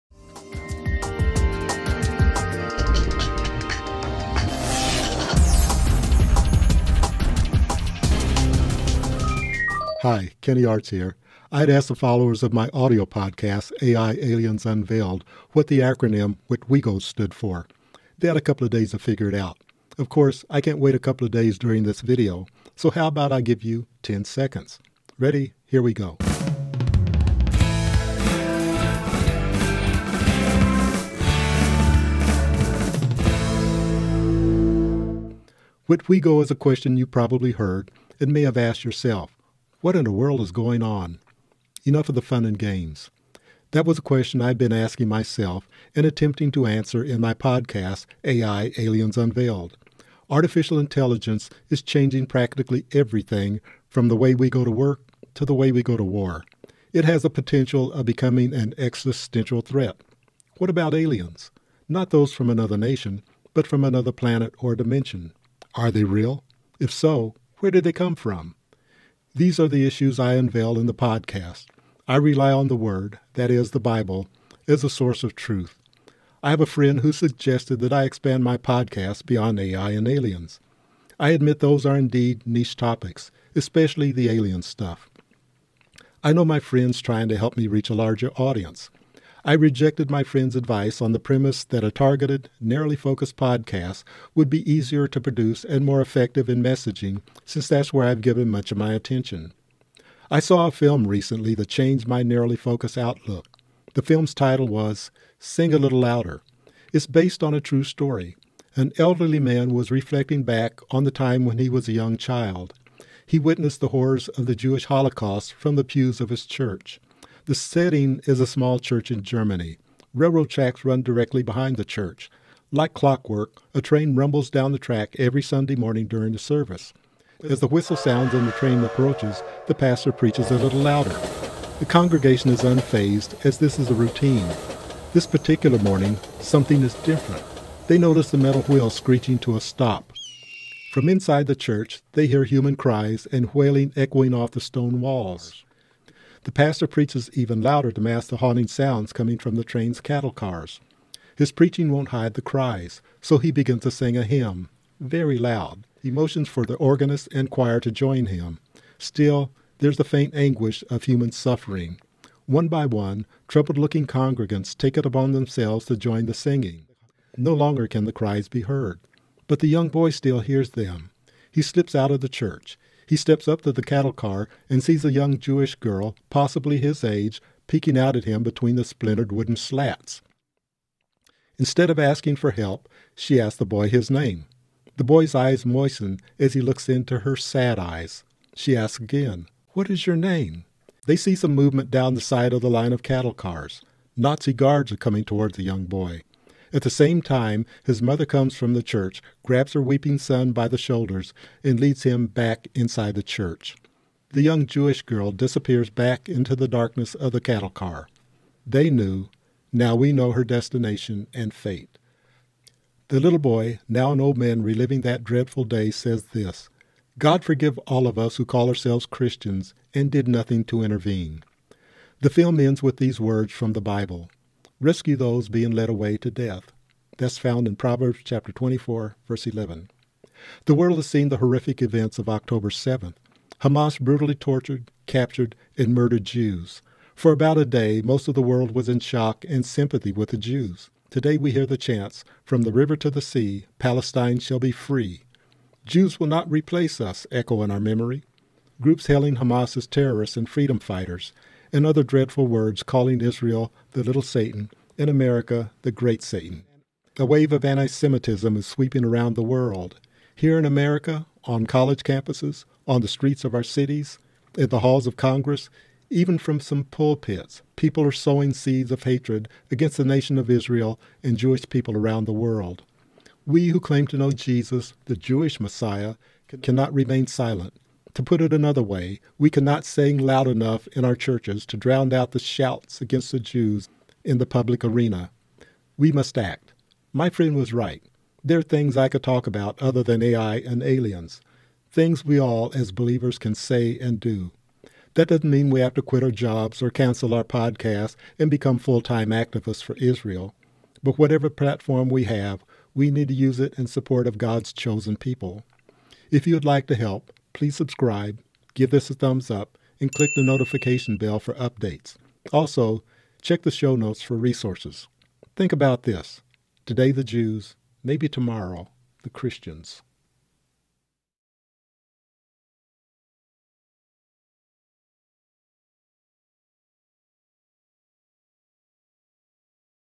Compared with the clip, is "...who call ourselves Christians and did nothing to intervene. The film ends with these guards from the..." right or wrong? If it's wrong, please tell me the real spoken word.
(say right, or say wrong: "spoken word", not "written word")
wrong: "words", not "guards".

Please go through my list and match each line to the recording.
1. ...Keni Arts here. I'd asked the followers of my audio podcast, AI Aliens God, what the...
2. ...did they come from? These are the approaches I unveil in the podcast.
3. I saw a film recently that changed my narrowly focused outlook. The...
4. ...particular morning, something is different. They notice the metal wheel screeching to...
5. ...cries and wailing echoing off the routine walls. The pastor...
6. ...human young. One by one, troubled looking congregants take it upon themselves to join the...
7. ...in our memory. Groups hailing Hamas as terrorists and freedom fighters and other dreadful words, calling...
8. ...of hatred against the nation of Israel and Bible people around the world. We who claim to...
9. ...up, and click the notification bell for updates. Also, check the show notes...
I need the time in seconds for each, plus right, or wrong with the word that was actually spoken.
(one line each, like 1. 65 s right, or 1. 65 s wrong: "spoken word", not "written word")
1. 10 s wrong: "Unveiled", not "God"
2. 67 s wrong: "issues", not "approaches"
3. 100 s right
4. 135 s right
5. 142 s wrong: "stone", not "routine"
6. 161 s wrong: "suffering", not "young"
7. 247 s right
8. 268 s wrong: "Jewish", not "Bible"
9. 309 s right.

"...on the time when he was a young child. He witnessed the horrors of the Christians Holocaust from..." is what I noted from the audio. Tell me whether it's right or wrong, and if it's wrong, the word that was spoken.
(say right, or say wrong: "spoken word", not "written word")
wrong: "Jewish", not "Christians".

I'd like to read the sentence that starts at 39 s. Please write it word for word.
What in the world is going on?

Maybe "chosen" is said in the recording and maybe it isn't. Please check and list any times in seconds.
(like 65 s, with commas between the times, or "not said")
304 s.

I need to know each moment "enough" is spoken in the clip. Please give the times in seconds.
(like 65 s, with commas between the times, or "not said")
41 s, 280 s.